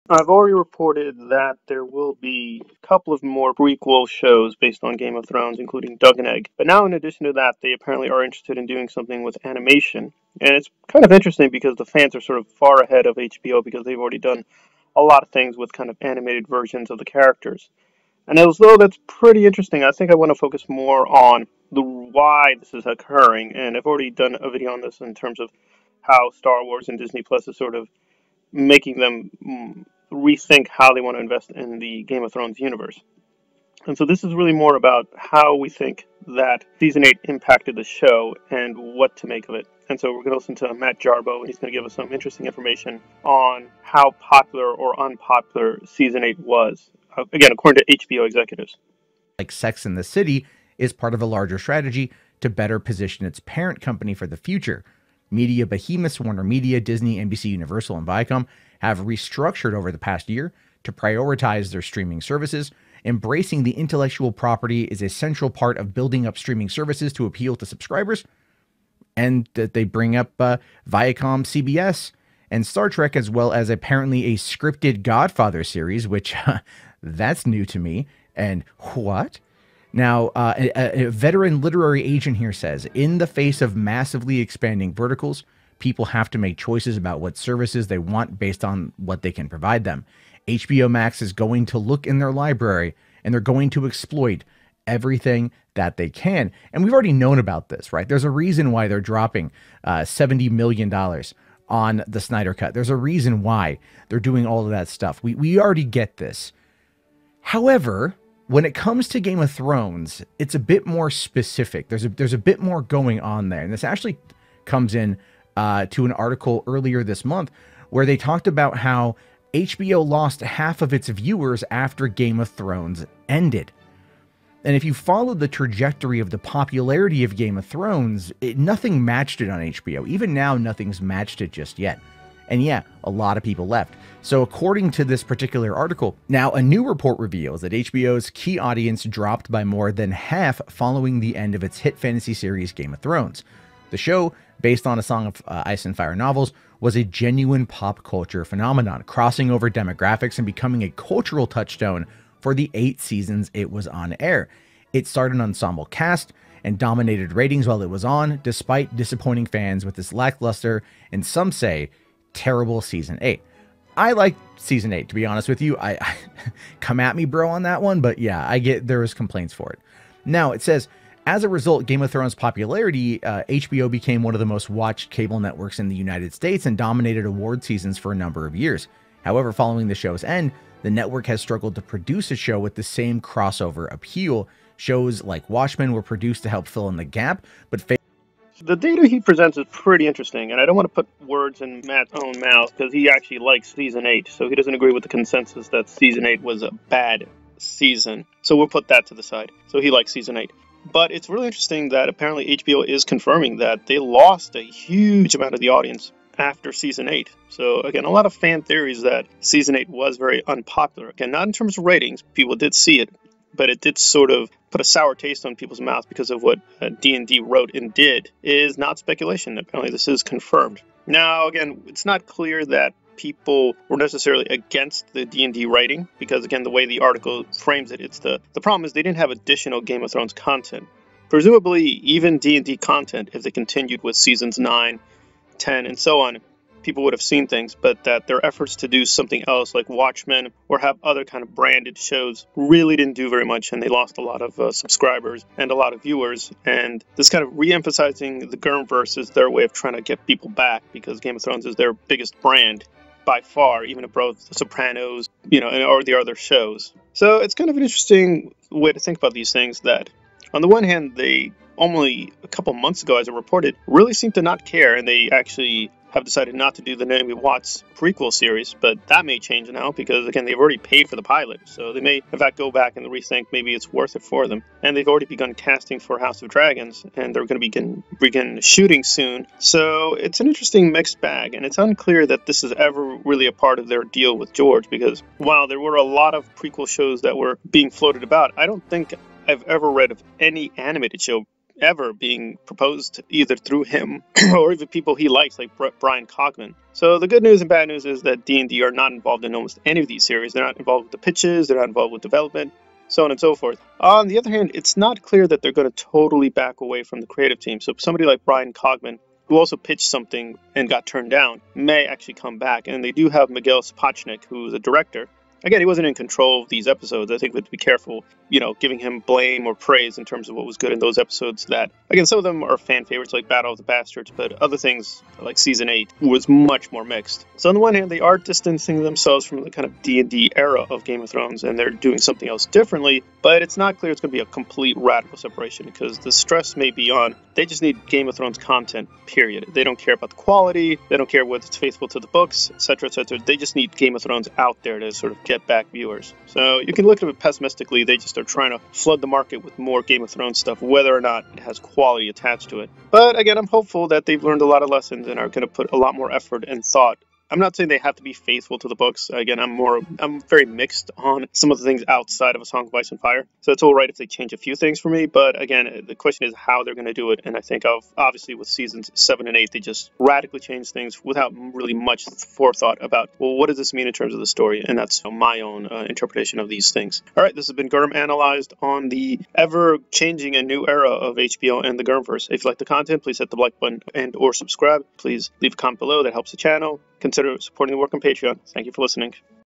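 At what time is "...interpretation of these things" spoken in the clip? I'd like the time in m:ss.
6:16.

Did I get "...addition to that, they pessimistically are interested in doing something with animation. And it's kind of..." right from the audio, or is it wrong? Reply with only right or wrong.
wrong.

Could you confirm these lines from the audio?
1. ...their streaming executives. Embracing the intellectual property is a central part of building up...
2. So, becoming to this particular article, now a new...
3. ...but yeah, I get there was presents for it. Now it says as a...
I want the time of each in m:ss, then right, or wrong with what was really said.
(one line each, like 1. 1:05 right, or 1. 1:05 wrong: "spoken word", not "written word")
1. 1:01 wrong: "services", not "executives"
2. 2:14 wrong: "according", not "becoming"
3. 2:48 wrong: "complaints", not "presents".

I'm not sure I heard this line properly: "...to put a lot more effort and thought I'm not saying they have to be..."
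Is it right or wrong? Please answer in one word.
right.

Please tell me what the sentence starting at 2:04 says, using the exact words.
And if you followed the trajectory of the popularity of Game of Thrones, it, nothing matched it on HBO.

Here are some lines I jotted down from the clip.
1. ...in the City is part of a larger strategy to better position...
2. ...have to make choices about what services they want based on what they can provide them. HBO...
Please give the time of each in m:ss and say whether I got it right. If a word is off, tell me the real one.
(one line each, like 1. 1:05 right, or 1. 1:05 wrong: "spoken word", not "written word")
1. 0:49 right
2. 1:26 right.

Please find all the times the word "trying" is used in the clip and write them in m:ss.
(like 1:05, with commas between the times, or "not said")
4:09, 5:48.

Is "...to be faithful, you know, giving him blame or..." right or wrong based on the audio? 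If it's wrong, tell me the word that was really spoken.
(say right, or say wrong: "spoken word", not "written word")
wrong: "careful", not "faithful".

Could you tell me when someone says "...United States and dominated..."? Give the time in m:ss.
2:55.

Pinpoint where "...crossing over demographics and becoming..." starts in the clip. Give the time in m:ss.
2:29.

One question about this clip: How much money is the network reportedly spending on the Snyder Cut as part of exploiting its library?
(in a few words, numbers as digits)
$70 million.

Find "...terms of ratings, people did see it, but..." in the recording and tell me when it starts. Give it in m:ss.
3:31.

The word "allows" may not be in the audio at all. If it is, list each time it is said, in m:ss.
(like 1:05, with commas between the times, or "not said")
not said.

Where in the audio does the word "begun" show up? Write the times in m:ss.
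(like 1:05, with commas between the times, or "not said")
4:35.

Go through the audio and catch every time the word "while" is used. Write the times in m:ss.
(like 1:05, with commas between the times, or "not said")
2:37, 4:45.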